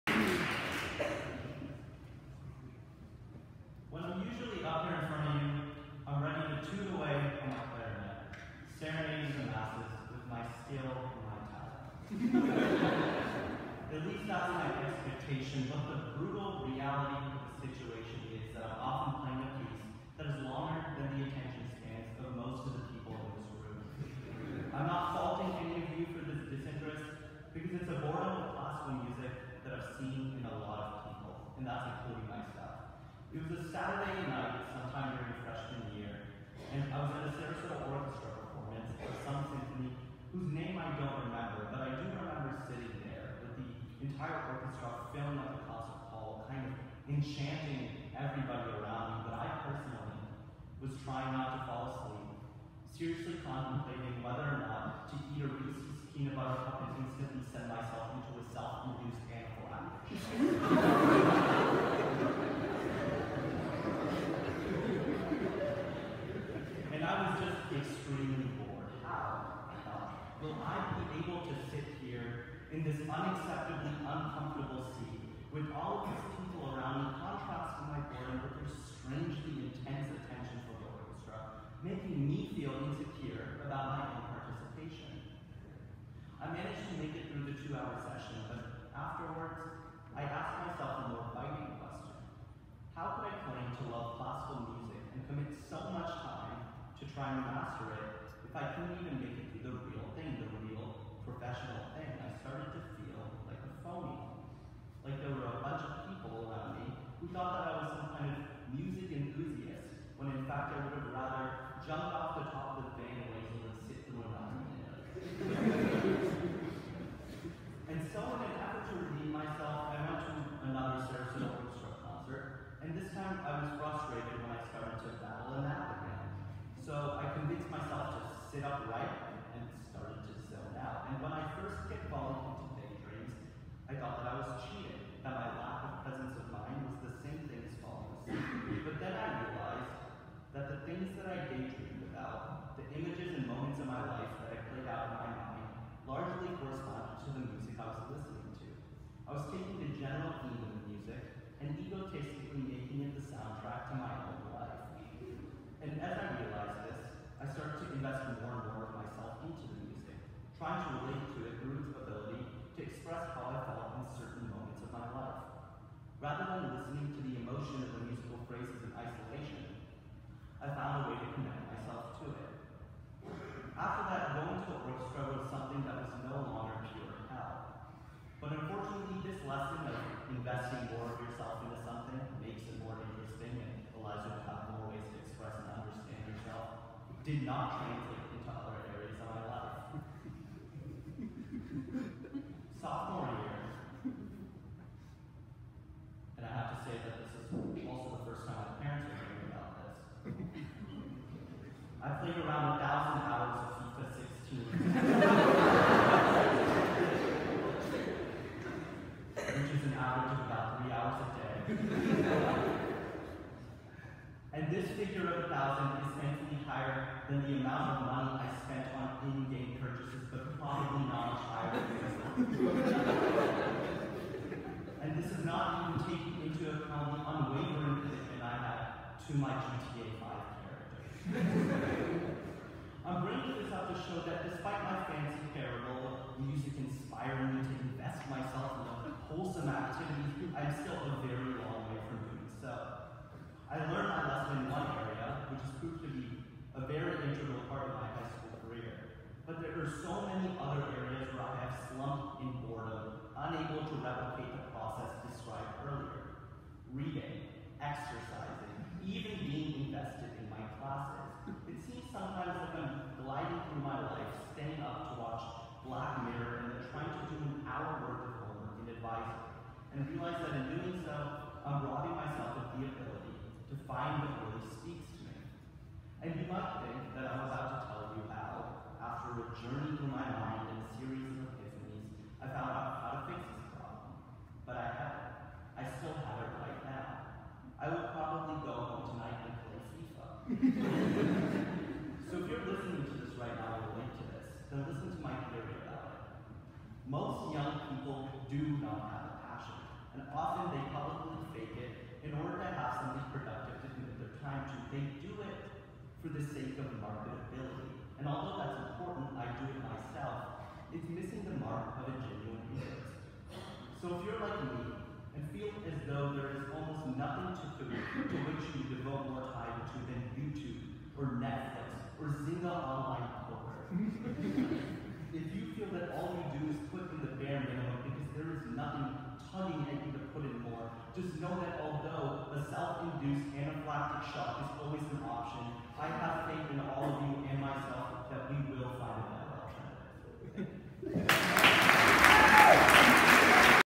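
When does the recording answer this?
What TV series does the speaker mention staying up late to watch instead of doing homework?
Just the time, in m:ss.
4:25.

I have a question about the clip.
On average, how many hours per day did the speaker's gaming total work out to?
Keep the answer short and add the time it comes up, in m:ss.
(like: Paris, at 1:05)
3, at 3:30.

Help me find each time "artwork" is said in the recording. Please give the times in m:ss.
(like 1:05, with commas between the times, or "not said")
not said.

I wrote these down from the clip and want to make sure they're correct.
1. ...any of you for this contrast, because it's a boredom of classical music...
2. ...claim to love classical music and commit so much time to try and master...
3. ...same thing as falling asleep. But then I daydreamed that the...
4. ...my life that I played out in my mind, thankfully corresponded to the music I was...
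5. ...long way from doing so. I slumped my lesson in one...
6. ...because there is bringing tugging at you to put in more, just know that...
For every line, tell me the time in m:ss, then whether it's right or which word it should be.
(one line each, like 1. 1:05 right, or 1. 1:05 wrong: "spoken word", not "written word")
1. 0:25 wrong: "disinterest", not "contrast"
2. 1:33 right
3. 2:17 wrong: "realized", not "daydreamed"
4. 2:23 wrong: "largely", not "thankfully"
5. 4:01 wrong: "learned", not "slumped"
6. 5:28 wrong: "nothing", not "bringing".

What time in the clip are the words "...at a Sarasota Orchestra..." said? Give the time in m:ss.
0:37.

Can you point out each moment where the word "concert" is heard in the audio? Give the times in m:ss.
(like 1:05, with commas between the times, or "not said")
0:45, 2:02.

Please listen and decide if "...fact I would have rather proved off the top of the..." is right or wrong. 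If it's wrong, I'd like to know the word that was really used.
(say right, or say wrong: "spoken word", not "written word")
wrong: "jumped", not "proved".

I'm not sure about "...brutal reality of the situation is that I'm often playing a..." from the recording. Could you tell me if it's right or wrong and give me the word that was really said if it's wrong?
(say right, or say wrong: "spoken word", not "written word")
right.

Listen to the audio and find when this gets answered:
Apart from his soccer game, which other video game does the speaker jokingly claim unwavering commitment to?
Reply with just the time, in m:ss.
3:49.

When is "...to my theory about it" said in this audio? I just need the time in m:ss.
4:55.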